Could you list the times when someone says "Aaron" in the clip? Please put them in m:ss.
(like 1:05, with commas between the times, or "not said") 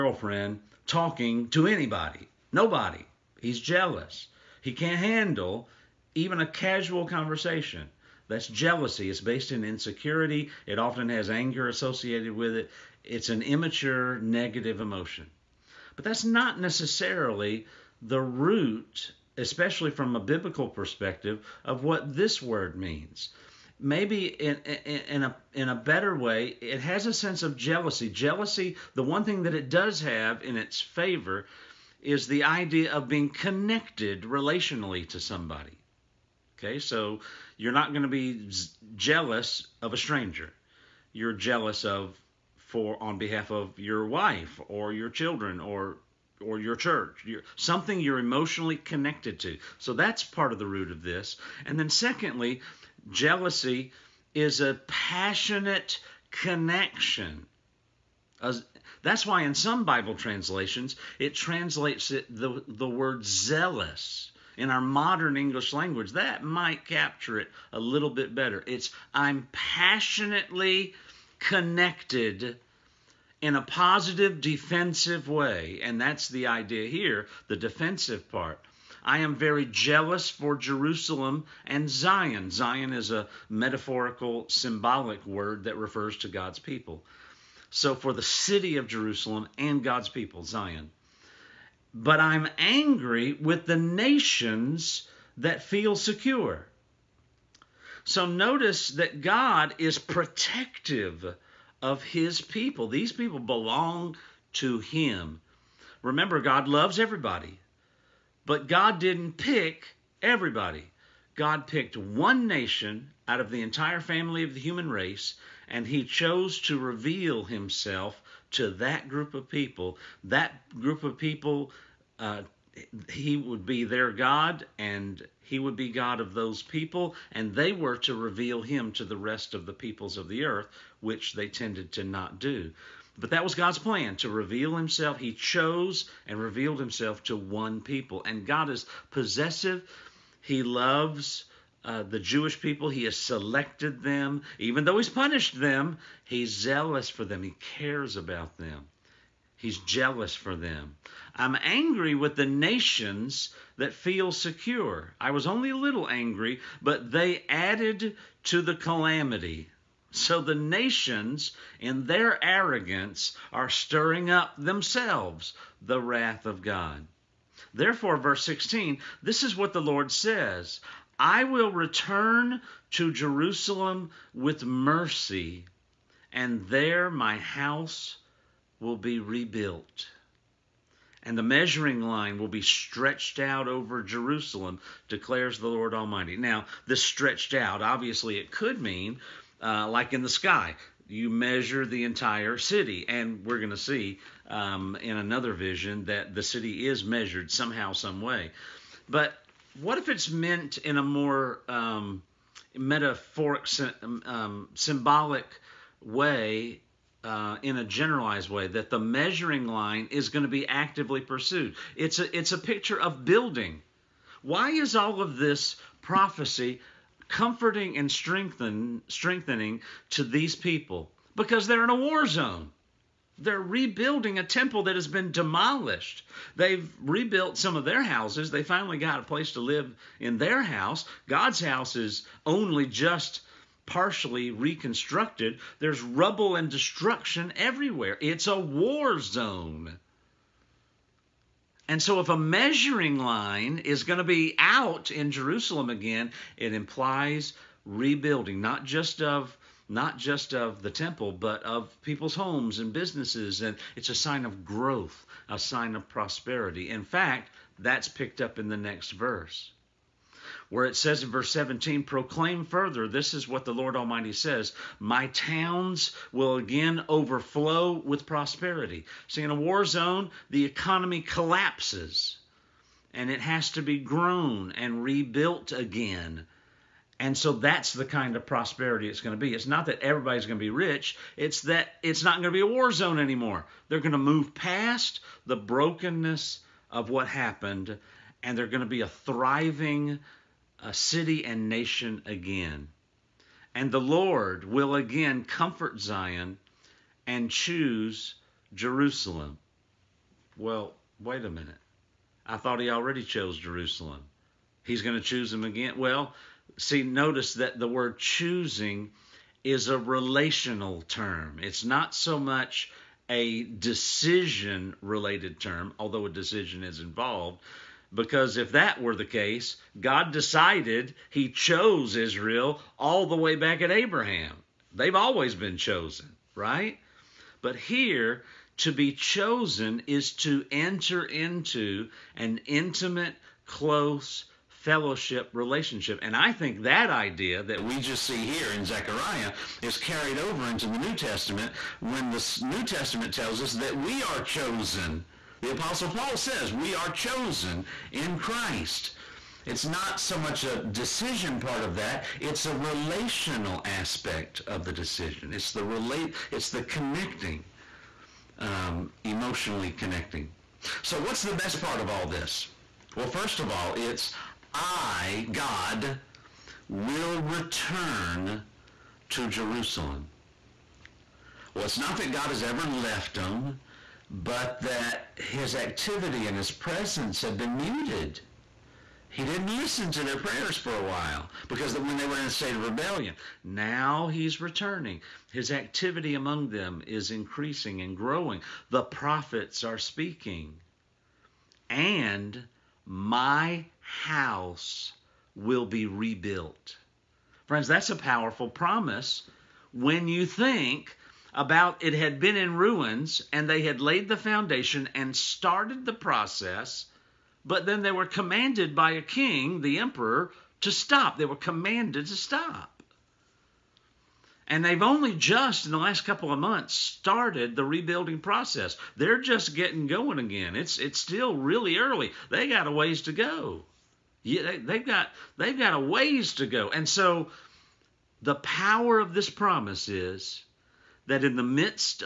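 not said.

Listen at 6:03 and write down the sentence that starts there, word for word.
Well, first of all, it's I, God, will return to Jerusalem.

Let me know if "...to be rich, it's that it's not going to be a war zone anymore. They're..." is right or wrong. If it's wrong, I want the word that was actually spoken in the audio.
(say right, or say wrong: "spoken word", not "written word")
right.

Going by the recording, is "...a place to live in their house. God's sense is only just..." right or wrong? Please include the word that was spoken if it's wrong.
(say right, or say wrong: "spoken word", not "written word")
wrong: "house", not "sense".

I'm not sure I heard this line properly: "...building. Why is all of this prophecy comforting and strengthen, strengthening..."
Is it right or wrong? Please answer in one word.
right.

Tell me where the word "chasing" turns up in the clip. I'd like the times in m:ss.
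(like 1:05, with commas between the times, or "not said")
not said.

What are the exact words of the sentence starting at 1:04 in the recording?
In our modern English language, that might capture it a little bit better.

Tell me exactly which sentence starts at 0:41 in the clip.
You're jealous of for on behalf of your wife or your children or or your church, your, something you're emotionally connected to.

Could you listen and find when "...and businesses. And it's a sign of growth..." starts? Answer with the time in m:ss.
4:12.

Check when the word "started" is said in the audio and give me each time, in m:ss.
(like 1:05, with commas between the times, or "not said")
6:45, 6:56.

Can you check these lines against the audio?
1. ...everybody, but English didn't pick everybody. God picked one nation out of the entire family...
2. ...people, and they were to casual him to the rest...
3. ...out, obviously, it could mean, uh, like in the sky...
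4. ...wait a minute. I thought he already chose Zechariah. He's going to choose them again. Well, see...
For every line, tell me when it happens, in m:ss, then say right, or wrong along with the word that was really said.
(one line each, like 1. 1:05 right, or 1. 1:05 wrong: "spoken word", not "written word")
1. 1:46 wrong: "God", not "English"
2. 2:06 wrong: "reveal", not "casual"
3. 3:07 right
4. 5:01 wrong: "Jerusalem", not "Zechariah".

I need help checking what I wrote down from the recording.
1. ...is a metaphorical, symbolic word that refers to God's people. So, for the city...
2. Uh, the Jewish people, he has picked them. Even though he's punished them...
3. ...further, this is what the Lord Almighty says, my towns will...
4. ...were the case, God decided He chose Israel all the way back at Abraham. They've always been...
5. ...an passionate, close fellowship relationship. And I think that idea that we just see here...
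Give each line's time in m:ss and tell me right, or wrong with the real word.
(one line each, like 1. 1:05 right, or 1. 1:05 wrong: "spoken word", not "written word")
1. 1:22 right
2. 2:21 wrong: "selected", not "picked"
3. 4:22 right
4. 5:18 right
5. 5:32 wrong: "intimate", not "passionate".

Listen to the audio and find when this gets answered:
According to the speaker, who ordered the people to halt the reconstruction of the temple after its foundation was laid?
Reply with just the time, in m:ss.
6:49.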